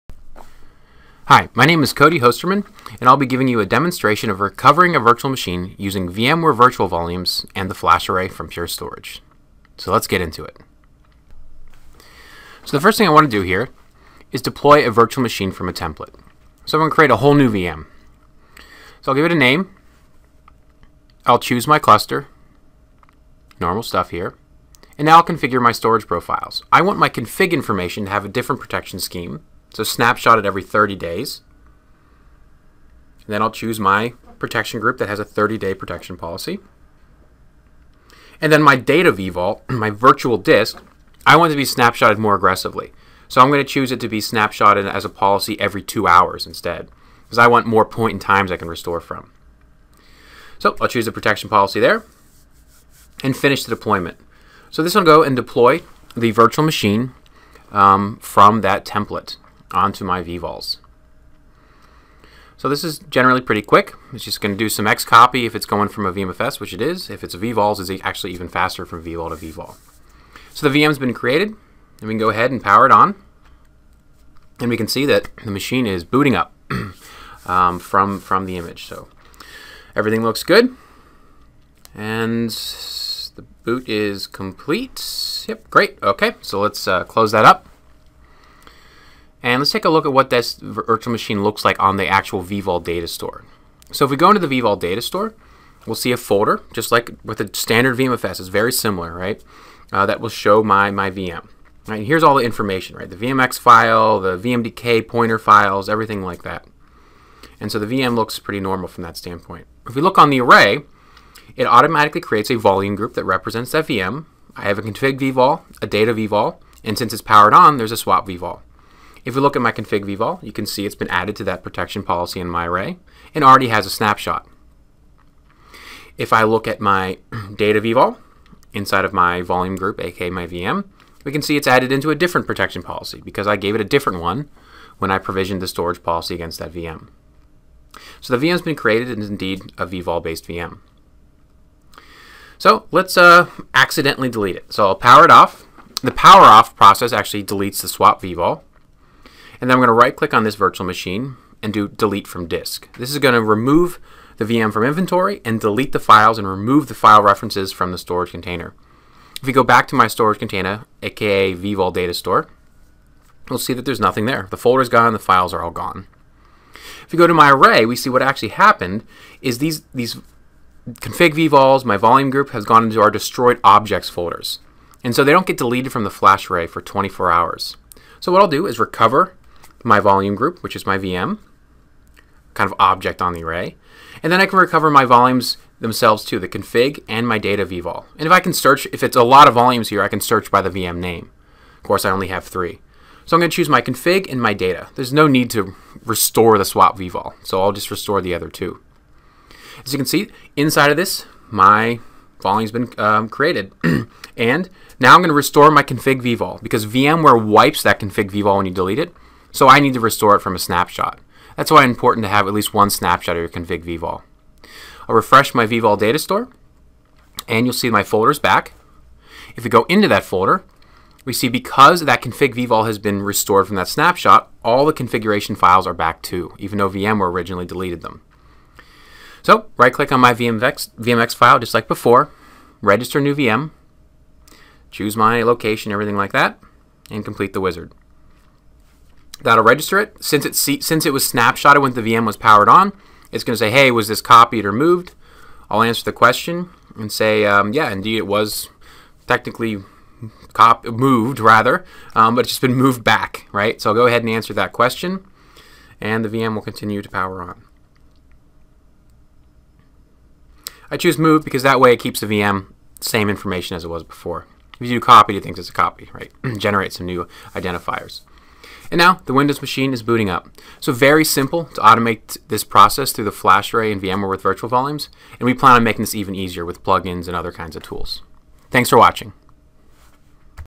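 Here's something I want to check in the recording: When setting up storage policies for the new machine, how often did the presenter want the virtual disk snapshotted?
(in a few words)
every 2 hours.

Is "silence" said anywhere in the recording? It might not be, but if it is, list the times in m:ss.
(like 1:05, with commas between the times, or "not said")
not said.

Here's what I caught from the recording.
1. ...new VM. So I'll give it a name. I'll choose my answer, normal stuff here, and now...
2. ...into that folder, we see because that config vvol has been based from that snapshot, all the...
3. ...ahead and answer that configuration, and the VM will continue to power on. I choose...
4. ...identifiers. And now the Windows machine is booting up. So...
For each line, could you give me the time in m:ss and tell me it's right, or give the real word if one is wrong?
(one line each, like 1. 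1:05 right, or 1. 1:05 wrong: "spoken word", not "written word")
1. 0:17 wrong: "cluster", not "answer"
2. 3:39 wrong: "restored", not "based"
3. 4:14 wrong: "question", not "configuration"
4. 4:27 right.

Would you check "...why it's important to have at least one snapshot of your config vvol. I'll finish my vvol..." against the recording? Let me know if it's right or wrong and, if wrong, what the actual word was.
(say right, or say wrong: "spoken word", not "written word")
wrong: "refresh", not "finish".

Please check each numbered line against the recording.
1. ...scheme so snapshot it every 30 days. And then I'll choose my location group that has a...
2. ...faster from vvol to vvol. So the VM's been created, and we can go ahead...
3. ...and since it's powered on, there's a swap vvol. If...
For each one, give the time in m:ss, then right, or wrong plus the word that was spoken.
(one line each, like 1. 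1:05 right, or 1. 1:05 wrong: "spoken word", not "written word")
1. 0:28 wrong: "protection", not "location"
2. 1:08 right
3. 1:56 right.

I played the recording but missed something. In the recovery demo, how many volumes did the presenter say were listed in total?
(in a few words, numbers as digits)
3.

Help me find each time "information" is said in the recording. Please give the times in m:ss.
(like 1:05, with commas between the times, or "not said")
0:27, 1:42, 4:23.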